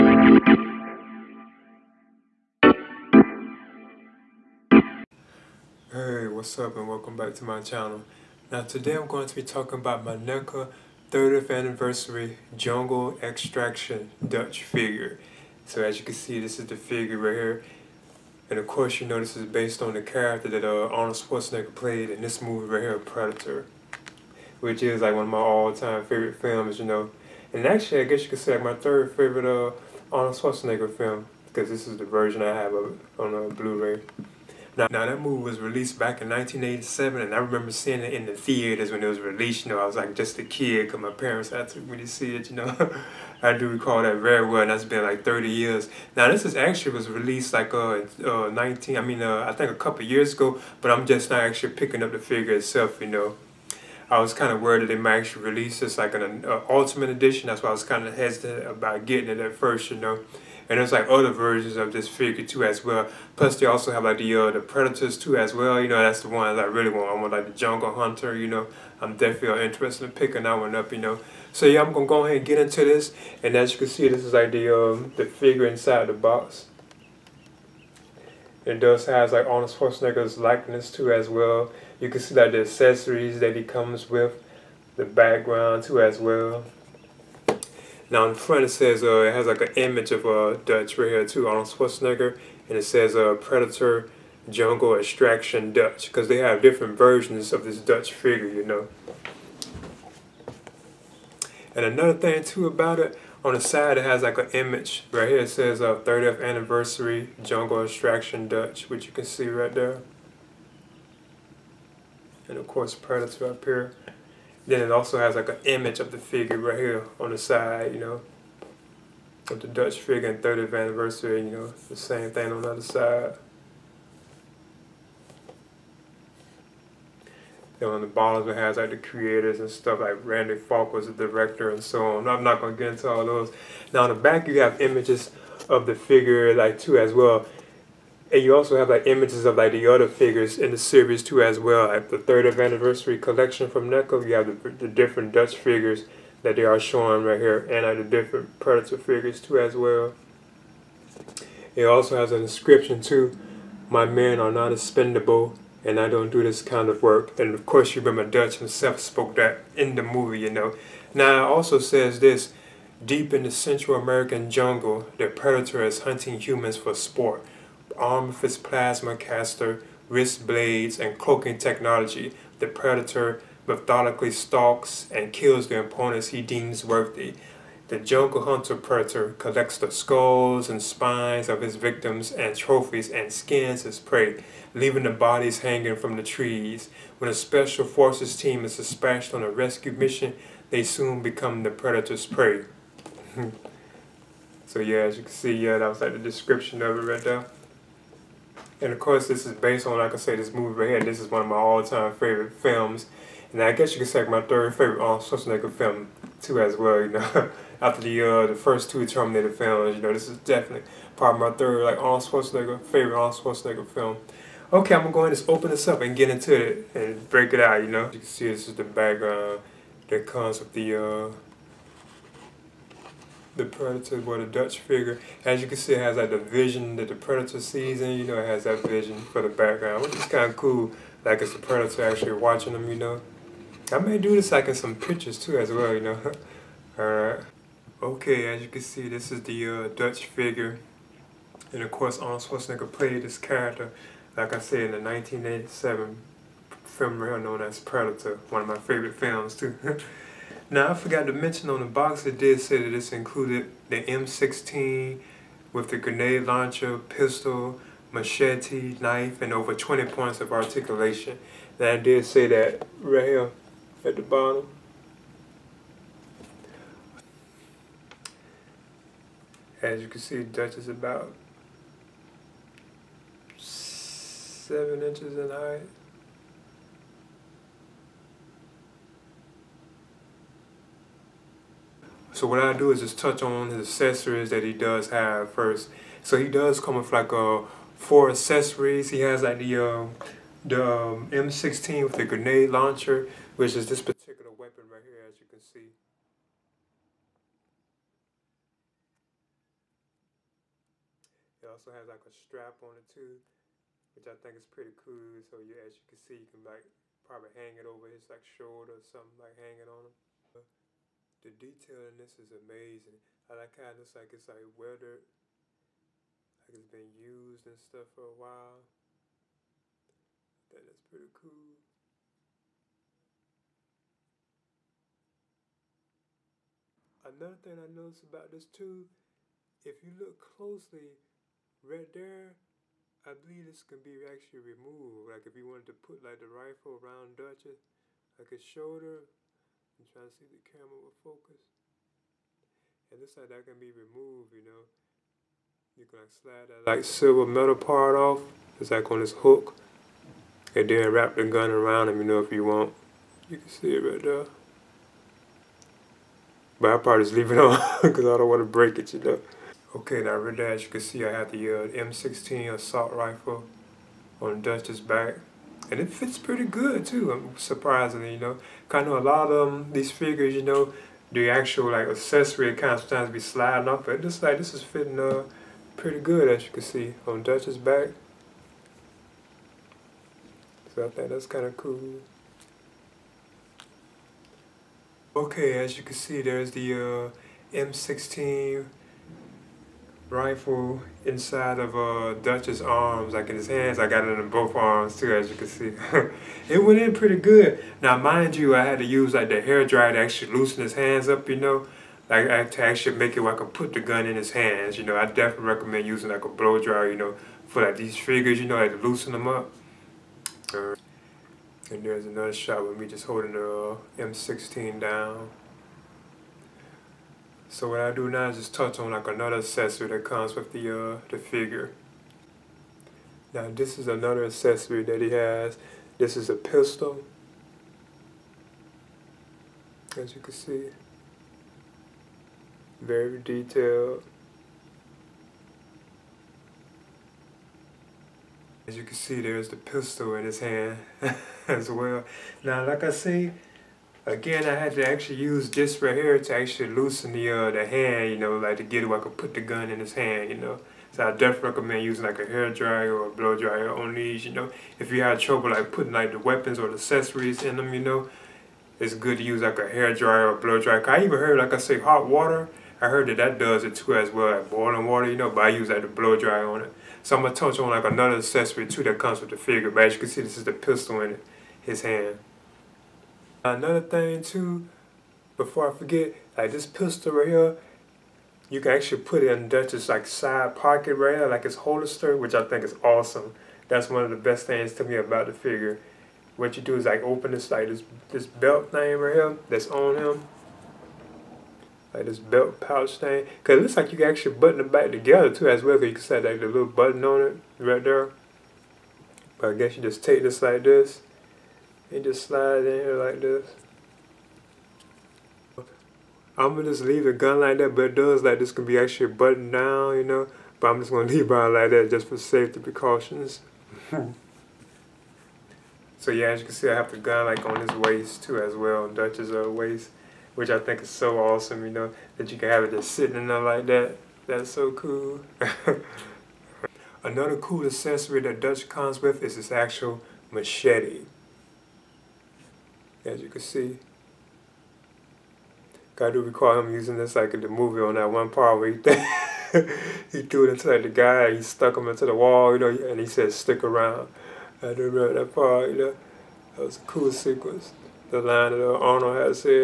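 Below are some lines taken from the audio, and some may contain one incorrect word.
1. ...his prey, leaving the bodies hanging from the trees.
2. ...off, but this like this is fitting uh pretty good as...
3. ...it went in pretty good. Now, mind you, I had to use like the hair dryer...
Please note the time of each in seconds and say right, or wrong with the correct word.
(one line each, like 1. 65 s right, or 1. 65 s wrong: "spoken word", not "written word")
1. 183 s right
2. 373 s right
3. 396 s right.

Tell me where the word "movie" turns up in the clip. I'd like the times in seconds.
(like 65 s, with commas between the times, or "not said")
22 s, 35 s, 160 s, 200 s, 537 s.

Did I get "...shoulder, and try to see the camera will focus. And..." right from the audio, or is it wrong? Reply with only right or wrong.
right.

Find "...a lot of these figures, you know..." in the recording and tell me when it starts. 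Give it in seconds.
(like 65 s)
369 s.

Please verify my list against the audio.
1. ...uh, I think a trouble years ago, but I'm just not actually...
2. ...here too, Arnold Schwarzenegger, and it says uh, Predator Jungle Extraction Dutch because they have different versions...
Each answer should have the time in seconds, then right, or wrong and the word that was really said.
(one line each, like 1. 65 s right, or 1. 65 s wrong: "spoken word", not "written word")
1. 49 s wrong: "couple", not "trouble"
2. 91 s right.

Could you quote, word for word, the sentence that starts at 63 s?
Plus they also have like the uh, the predators too as well.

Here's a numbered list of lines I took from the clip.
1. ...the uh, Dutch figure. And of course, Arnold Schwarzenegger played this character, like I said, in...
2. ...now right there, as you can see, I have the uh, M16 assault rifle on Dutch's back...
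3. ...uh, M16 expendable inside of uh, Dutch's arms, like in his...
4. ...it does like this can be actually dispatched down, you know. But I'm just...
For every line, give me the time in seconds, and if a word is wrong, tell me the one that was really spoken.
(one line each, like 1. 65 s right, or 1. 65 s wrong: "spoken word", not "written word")
1. 239 s right
2. 360 s right
3. 386 s wrong: "rifle", not "expendable"
4. 508 s wrong: "buttoned", not "dispatched".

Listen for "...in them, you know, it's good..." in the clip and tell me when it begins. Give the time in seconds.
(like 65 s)
457 s.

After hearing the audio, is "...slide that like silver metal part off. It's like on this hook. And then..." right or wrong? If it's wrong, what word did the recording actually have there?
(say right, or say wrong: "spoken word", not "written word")
right.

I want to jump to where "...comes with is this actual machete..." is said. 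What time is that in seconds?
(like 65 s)
528 s.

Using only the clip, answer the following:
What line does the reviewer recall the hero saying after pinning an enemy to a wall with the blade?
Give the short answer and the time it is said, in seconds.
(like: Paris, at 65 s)
stick around, at 543 s.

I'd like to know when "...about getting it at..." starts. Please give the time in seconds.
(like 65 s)
58 s.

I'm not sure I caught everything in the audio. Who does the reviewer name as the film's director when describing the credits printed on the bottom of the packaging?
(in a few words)
Randy Falk.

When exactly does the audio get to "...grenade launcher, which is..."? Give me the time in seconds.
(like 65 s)
292 s.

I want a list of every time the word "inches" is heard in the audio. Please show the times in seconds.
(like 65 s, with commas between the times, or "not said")
275 s.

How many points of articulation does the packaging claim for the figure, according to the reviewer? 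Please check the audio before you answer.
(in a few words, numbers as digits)
over 20.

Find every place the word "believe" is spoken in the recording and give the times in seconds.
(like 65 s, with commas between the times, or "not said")
333 s.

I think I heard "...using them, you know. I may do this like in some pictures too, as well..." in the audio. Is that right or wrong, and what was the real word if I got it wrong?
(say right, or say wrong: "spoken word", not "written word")
wrong: "watching", not "using".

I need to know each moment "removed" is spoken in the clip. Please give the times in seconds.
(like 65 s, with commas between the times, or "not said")
334 s, 343 s.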